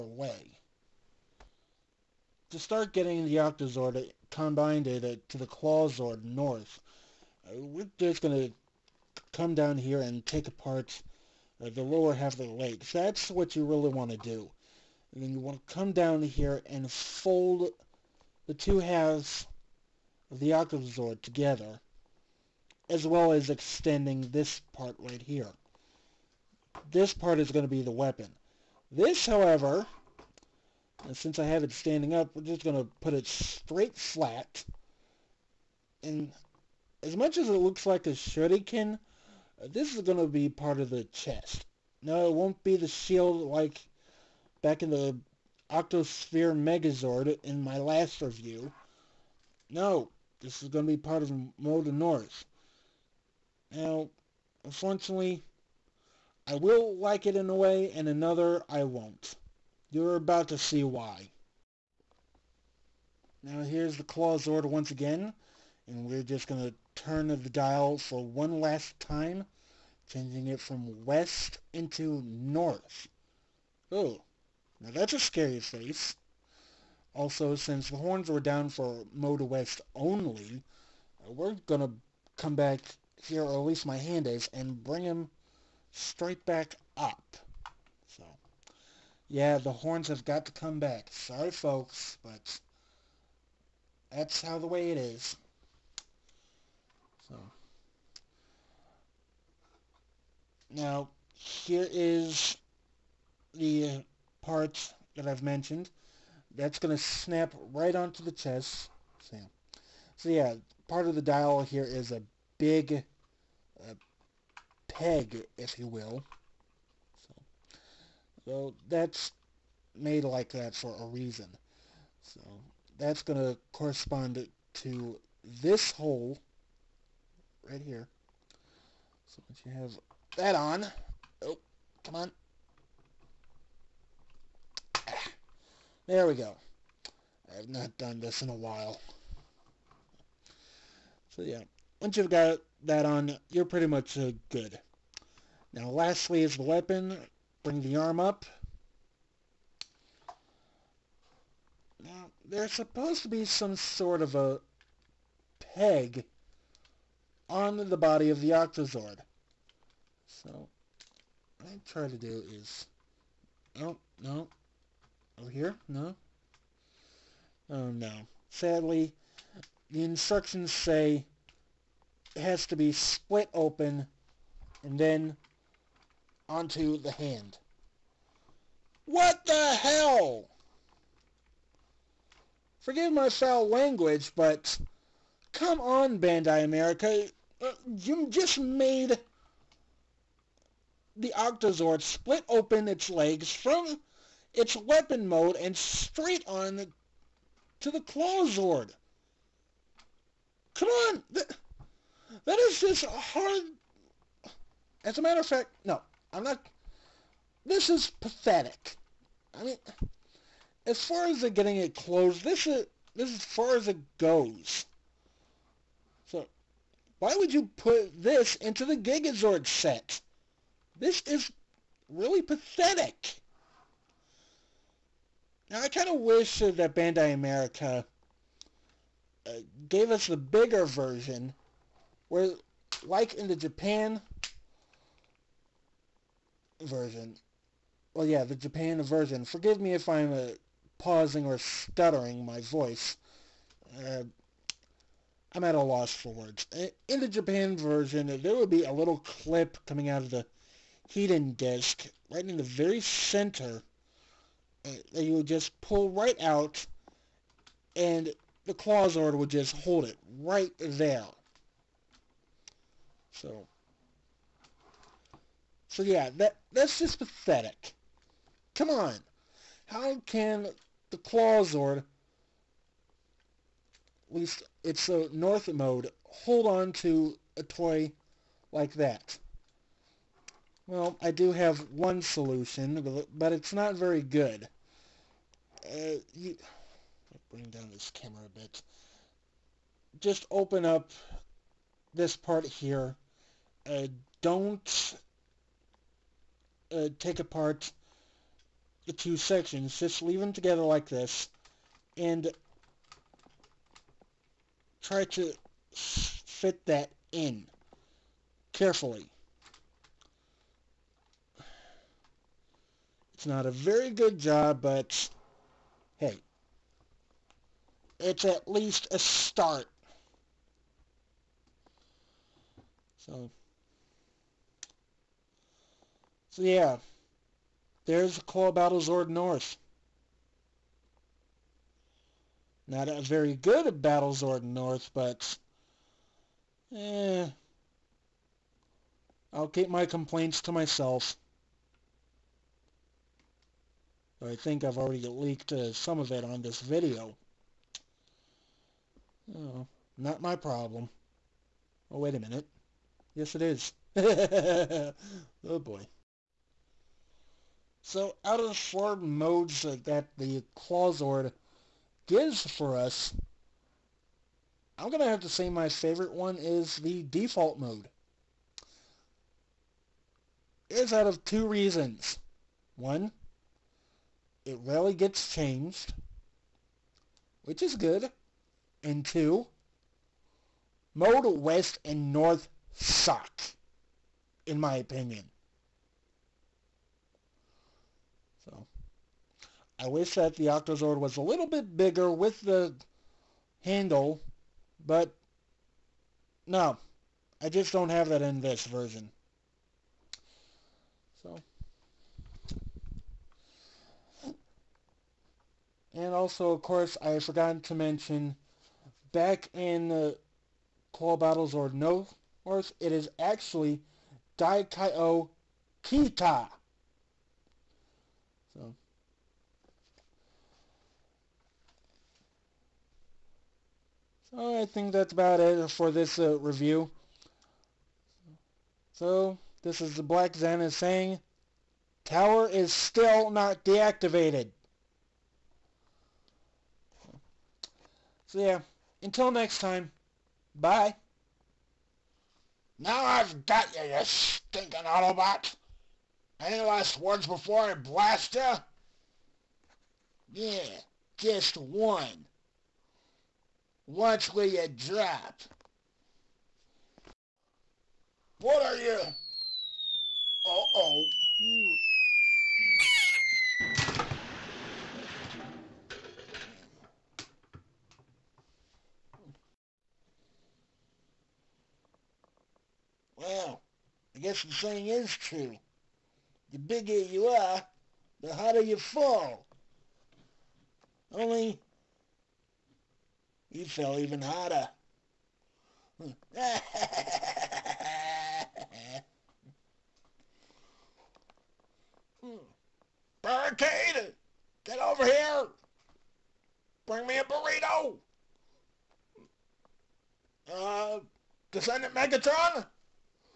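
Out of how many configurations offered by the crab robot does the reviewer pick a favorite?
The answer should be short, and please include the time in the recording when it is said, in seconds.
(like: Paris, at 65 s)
4, at 358 s.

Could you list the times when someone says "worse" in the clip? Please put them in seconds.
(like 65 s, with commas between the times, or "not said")
412 s.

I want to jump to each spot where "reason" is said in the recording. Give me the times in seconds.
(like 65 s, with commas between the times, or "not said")
121 s, 371 s.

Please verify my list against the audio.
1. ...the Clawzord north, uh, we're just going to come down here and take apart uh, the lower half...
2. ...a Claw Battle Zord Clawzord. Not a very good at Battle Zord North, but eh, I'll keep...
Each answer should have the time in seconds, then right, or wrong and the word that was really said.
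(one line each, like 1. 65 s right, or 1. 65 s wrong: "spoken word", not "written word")
1. 5 s right
2. 328 s wrong: "North", not "Clawzord".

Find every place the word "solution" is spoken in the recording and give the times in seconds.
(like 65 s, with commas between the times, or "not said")
282 s.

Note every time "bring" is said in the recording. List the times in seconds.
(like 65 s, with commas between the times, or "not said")
84 s, 147 s, 287 s, 497 s.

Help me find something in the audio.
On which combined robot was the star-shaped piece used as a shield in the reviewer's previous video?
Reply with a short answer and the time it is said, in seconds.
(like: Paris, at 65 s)
Octospear Megazord, at 45 s.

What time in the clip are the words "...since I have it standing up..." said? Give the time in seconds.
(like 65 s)
31 s.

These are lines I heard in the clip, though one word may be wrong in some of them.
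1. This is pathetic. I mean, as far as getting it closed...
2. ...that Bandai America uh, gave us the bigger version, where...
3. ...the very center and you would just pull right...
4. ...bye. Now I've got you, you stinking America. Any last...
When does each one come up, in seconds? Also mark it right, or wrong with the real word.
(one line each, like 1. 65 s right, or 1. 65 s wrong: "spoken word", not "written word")
1. 207 s right
2. 226 s right
3. 252 s right
4. 440 s wrong: "Autobot", not "America".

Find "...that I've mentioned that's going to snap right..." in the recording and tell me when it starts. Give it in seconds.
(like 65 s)
105 s.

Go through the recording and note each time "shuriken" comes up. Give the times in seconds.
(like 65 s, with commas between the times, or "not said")
38 s.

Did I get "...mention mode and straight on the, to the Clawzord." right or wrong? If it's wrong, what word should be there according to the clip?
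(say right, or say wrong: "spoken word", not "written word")
wrong: "weapon", not "mention".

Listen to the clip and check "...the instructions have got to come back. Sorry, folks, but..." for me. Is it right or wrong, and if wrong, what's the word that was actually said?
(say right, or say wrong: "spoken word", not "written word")
wrong: "horns", not "instructions".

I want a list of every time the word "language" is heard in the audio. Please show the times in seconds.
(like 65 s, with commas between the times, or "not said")
183 s.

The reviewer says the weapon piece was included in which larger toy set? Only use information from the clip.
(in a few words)
Gigazord set.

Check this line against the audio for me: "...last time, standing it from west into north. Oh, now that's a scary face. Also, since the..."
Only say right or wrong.
wrong.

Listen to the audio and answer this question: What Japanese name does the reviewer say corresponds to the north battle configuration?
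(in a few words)
Daikai-Oh Kita.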